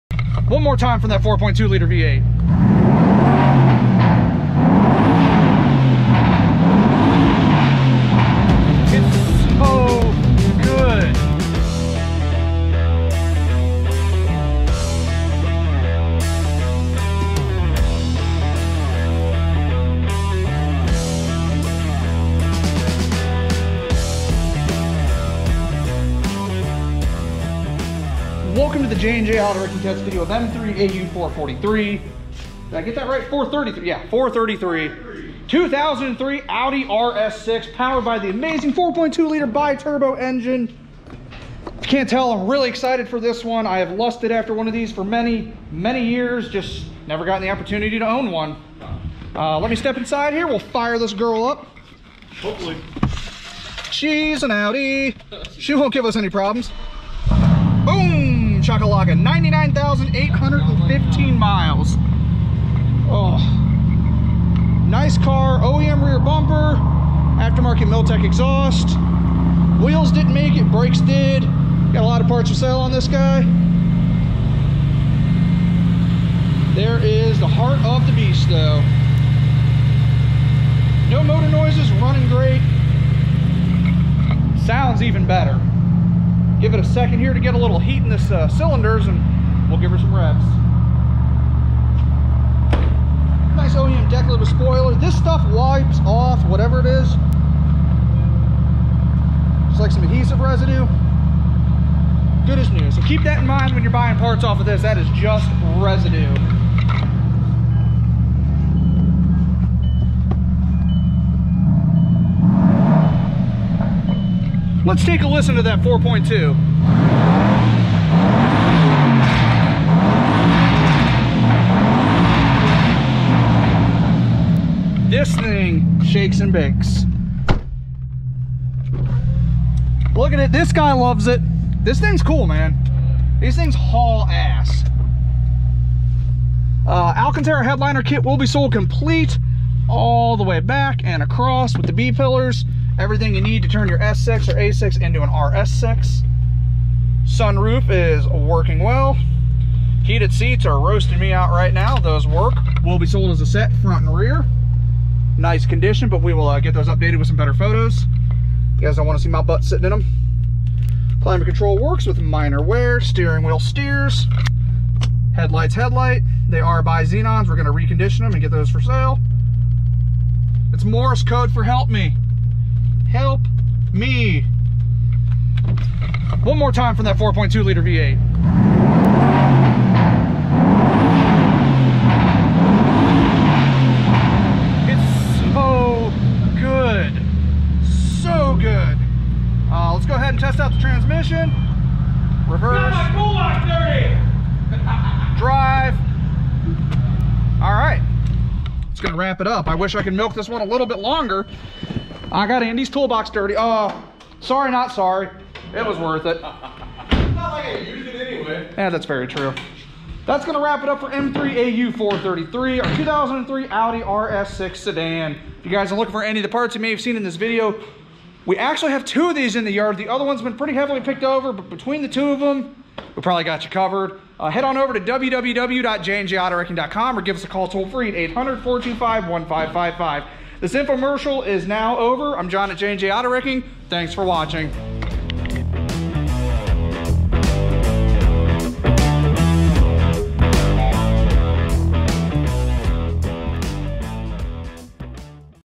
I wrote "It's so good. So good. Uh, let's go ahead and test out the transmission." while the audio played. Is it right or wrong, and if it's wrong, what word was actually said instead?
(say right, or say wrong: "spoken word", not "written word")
right.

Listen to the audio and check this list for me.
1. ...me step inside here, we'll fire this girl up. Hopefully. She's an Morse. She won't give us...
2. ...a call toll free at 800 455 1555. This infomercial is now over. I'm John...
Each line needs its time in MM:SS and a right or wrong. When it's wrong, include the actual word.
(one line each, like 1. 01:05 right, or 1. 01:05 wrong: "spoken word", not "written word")
1. 00:49 wrong: "Audi", not "Morse"
2. 03:47 wrong: "425", not "455".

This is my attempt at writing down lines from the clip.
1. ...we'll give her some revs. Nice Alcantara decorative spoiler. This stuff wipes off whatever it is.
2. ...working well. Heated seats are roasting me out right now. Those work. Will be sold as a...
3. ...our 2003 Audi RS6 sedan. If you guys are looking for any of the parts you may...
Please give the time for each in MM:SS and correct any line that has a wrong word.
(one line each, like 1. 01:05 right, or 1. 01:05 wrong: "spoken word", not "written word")
1. 01:29 wrong: "OEM", not "Alcantara"
2. 02:28 right
3. 03:32 right.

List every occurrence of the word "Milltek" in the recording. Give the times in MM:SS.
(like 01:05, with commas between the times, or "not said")
01:07.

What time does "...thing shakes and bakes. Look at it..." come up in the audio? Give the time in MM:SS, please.
02:05.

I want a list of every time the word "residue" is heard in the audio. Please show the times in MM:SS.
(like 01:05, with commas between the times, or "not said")
01:40, 01:45.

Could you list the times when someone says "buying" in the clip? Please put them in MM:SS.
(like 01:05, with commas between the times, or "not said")
01:43.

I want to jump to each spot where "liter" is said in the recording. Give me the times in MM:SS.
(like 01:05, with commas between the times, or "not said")
00:01, 00:39, 02:57.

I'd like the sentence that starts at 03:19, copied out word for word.
I wish I could milk this one a little bit longer.